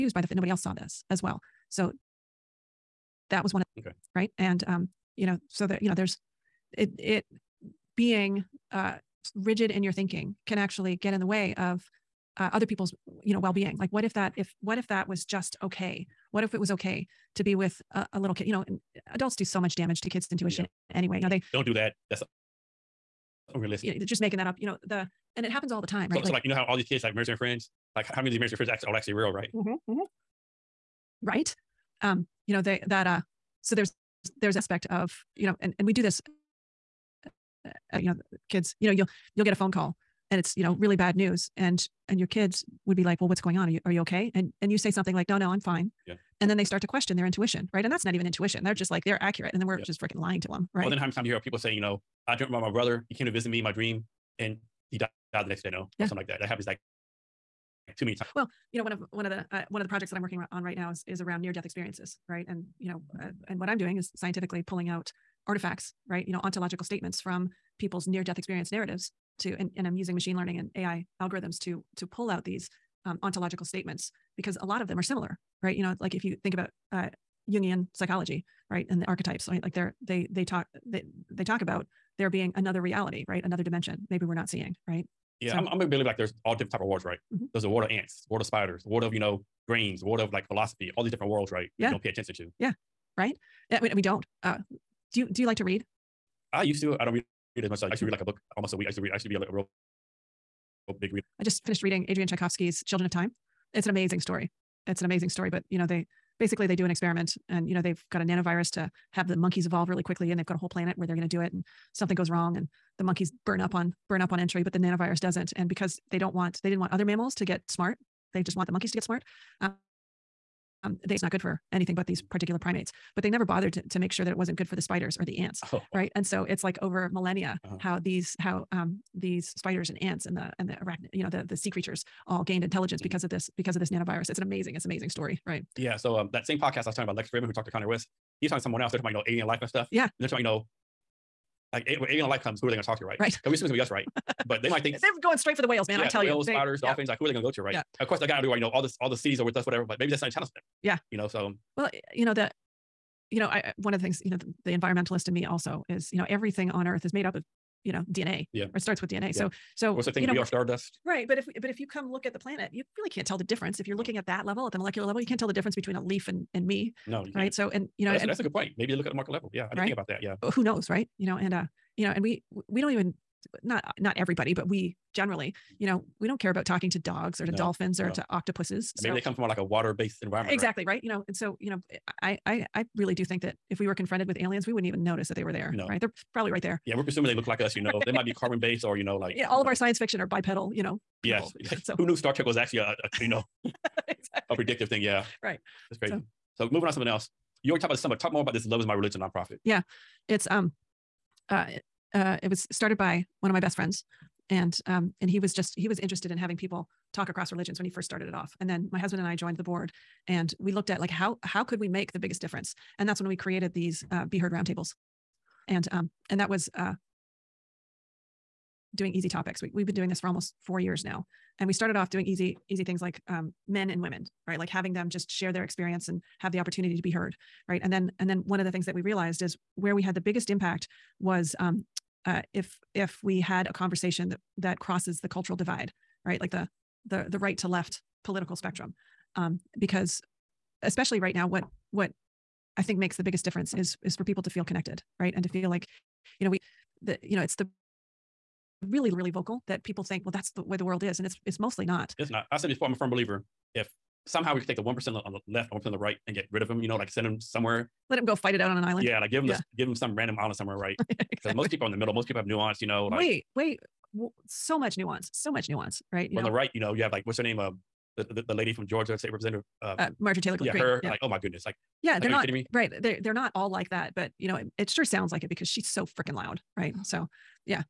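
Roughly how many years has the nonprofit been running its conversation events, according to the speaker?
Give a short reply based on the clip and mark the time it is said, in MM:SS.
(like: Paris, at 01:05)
almost 4 years, at 03:40.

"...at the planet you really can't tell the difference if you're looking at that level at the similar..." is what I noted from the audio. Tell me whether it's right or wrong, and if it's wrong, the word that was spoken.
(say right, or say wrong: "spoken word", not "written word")
wrong: "molecular", not "similar".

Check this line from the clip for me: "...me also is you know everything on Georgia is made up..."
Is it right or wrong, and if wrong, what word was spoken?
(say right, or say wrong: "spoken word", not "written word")
wrong: "Earth", not "Georgia".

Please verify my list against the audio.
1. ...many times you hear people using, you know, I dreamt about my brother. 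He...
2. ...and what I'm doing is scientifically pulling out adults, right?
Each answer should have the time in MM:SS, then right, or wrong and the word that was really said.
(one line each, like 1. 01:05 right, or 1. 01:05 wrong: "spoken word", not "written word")
1. 00:51 wrong: "saying", not "using"
2. 01:03 wrong: "artifacts", not "adults".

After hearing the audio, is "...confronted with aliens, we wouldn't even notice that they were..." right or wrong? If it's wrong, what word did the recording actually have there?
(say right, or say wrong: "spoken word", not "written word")
right.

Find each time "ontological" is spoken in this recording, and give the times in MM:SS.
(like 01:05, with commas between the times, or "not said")
01:06, 01:13.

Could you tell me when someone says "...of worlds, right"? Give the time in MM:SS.
01:26.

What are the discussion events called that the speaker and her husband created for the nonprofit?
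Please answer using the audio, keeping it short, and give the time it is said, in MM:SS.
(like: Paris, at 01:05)
Be heard roundtables, at 03:34.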